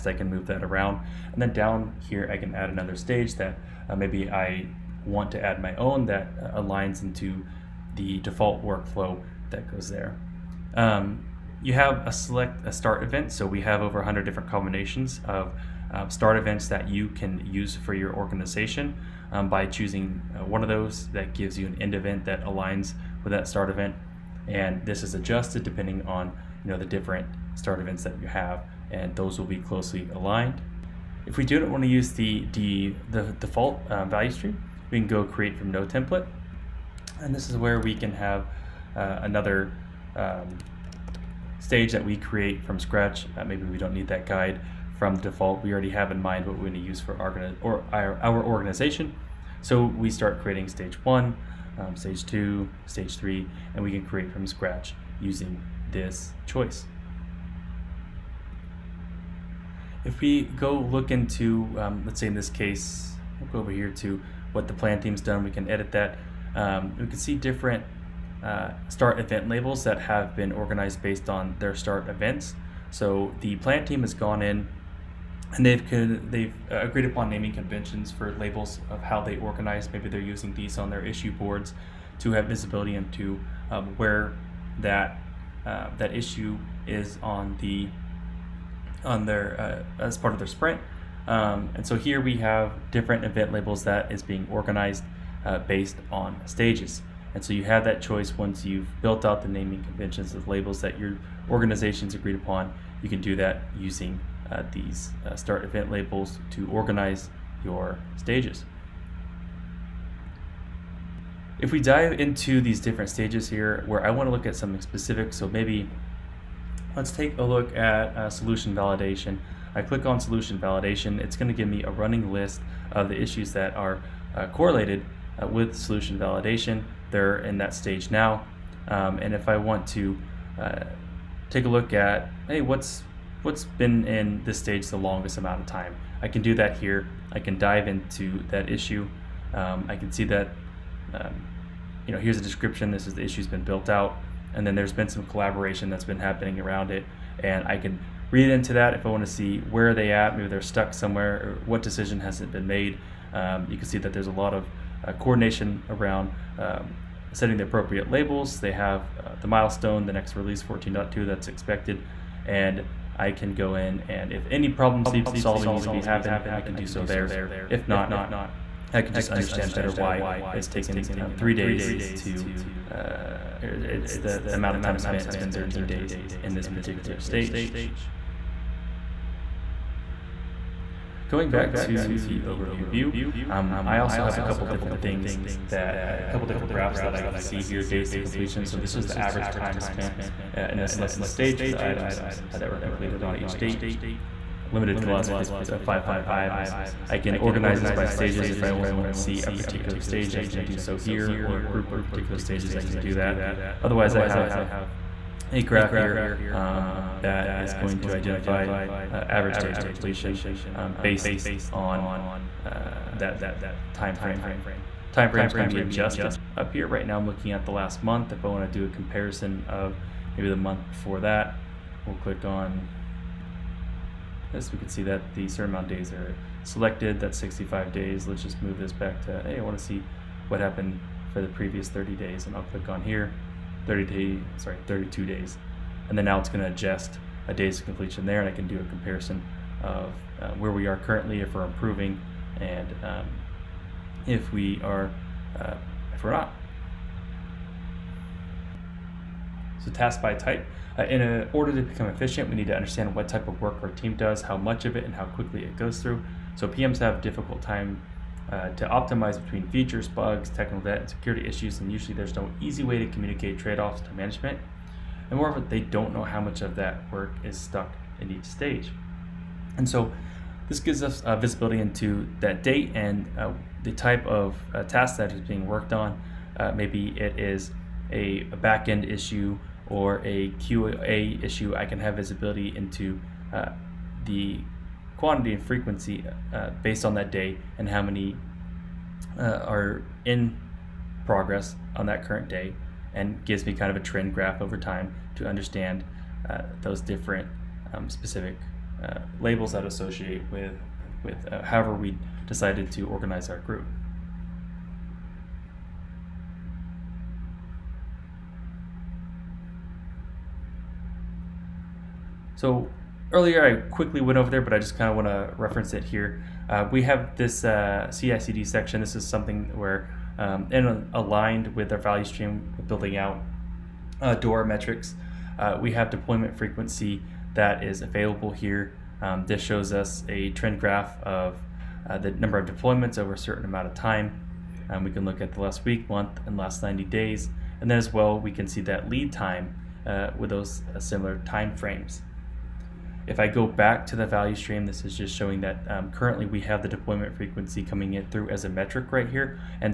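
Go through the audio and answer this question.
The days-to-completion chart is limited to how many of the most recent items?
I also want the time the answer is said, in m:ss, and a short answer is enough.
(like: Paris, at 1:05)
500, at 3:15.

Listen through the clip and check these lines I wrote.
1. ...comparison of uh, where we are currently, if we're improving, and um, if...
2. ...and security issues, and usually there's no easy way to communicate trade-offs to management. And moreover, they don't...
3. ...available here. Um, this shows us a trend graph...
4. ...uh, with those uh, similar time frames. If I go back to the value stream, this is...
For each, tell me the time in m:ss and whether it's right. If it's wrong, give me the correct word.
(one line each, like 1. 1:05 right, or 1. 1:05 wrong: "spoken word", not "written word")
1. 3:58 right
2. 4:20 right
3. 5:28 right
4. 5:40 right.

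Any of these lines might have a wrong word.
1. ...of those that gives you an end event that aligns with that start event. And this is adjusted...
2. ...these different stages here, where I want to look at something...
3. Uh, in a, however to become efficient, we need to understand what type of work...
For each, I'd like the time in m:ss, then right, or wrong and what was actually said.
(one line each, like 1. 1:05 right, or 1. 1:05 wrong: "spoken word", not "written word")
1. 0:20 right
2. 1:52 right
3. 4:10 wrong: "order", not "however".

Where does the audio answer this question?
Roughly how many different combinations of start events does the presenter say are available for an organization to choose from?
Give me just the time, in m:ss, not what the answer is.
0:13.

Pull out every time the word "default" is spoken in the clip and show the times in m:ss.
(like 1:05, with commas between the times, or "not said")
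0:08, 0:33, 0:45.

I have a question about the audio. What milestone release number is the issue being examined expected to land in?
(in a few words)
14.2.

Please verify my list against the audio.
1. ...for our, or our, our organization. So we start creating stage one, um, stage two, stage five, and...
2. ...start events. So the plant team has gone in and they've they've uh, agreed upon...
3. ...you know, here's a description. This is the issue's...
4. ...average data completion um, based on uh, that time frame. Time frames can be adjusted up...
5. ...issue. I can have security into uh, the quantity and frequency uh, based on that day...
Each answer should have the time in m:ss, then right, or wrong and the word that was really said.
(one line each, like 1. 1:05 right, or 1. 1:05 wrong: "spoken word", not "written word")
1. 0:46 wrong: "three", not "five"
2. 1:11 right
3. 2:22 right
4. 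3:29 right
5. 4:41 wrong: "visibility", not "security".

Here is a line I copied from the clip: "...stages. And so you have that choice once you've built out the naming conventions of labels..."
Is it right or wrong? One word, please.
right.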